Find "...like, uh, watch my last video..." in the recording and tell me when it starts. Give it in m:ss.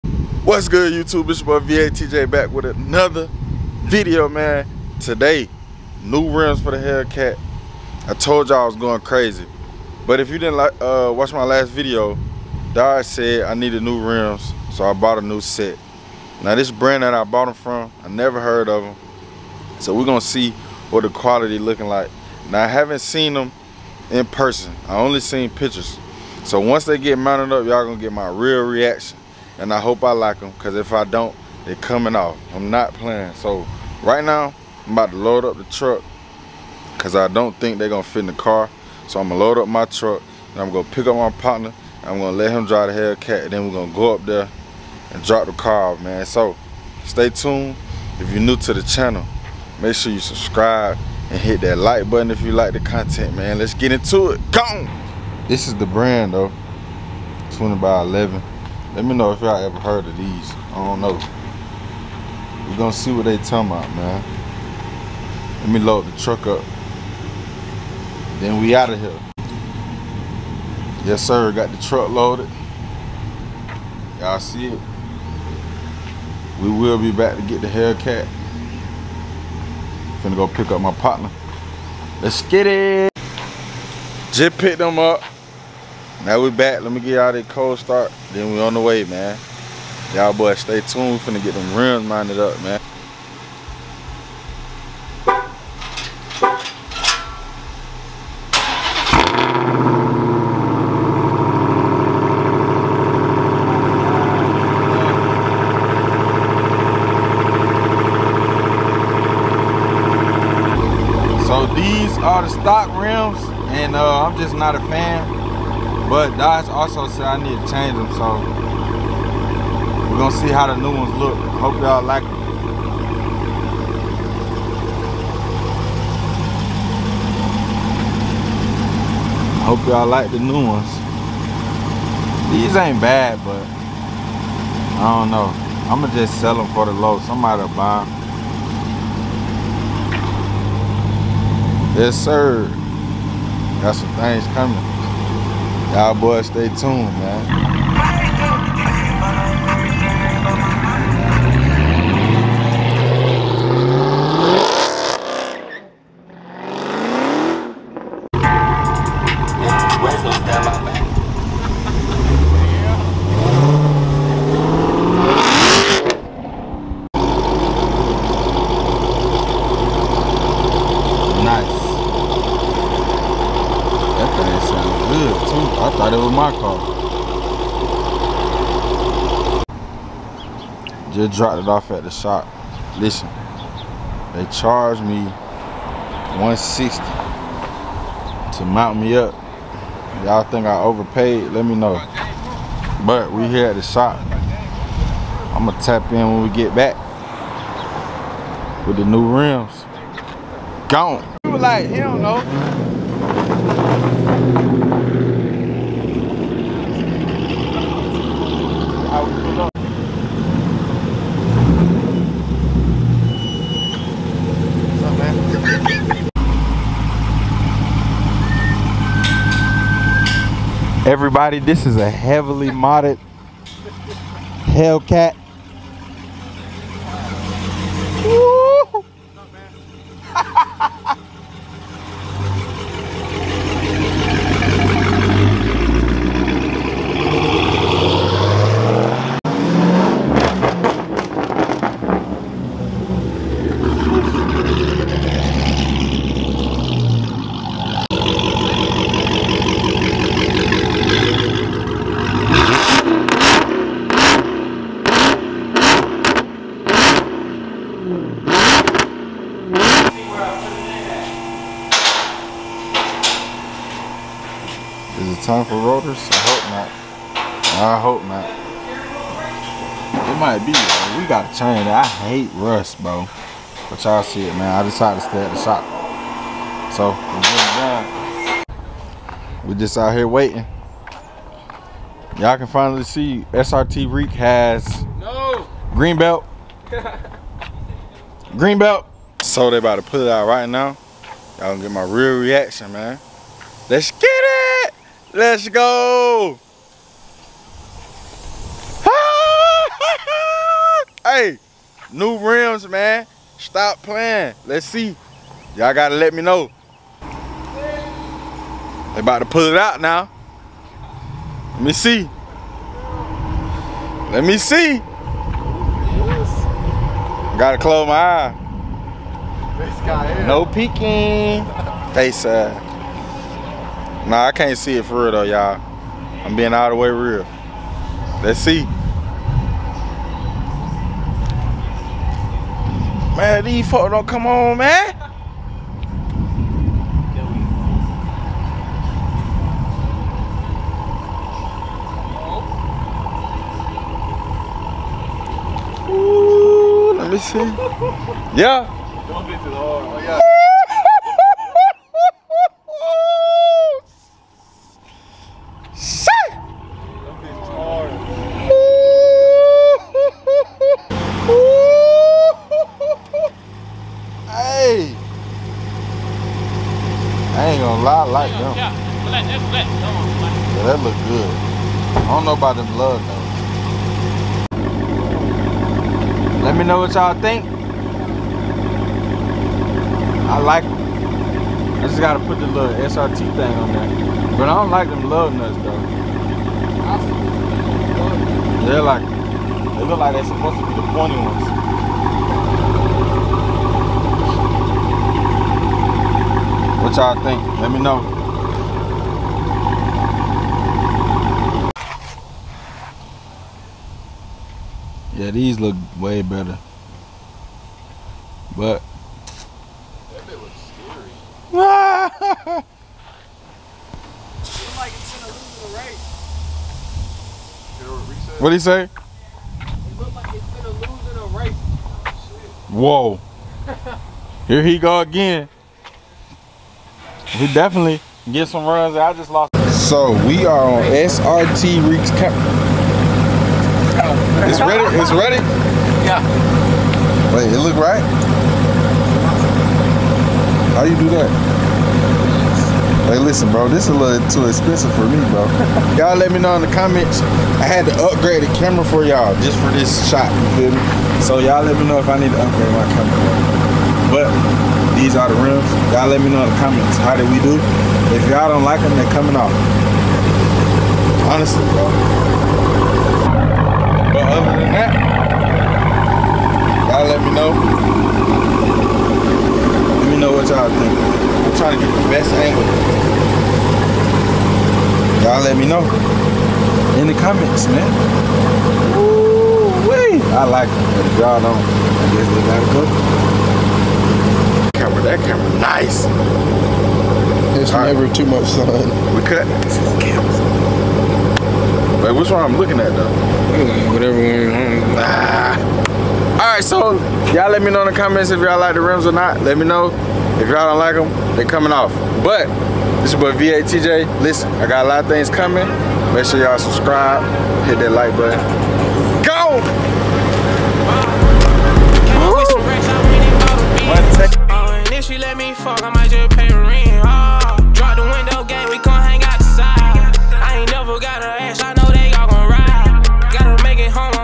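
0:10.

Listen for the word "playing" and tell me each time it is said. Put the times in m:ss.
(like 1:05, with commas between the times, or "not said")
0:32, 5:04.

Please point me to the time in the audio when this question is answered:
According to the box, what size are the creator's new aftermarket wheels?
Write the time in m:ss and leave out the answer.
0:57.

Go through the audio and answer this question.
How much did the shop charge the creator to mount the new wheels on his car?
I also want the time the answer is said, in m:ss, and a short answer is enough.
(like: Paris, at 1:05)
160, at 3:06.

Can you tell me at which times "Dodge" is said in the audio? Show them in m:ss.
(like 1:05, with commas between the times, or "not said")
0:12, 1:56.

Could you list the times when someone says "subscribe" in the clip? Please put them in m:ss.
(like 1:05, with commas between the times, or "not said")
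0:50, 8:26.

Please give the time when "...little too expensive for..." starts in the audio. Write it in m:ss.
7:24.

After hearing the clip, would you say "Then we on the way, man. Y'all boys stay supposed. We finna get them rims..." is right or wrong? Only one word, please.
wrong.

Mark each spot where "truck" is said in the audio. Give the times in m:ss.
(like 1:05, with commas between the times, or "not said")
0:35, 0:39, 1:06, 1:11.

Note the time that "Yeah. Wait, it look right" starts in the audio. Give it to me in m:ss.
7:16.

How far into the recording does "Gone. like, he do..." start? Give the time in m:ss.
3:20.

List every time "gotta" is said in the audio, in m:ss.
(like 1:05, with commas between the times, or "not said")
5:05, 5:17, 6:22, 8:02.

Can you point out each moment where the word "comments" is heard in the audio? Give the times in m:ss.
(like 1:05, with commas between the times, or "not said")
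7:26, 7:36, 7:57, 8:18.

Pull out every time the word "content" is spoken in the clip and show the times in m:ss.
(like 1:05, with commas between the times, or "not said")
0:52.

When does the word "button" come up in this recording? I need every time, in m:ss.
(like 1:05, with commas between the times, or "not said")
0:52, 8:28.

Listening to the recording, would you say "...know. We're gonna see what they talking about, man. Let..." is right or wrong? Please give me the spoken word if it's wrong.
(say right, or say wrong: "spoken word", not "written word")
right.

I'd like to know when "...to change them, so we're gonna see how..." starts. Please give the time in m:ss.
1:57.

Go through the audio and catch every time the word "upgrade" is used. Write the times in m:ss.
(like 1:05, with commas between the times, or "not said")
7:28, 7:32.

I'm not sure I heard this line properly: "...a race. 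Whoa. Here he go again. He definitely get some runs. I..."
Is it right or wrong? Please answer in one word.
right.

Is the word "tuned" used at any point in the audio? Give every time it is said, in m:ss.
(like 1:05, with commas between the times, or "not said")
0:47, 1:30, 2:26.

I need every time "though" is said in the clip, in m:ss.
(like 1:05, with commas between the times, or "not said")
0:56, 5:25, 6:25, 8:13.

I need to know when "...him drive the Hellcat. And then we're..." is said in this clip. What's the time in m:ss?
0:42.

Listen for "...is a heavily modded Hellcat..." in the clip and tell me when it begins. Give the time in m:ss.
3:41.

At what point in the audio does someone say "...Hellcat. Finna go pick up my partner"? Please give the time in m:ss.
1:17.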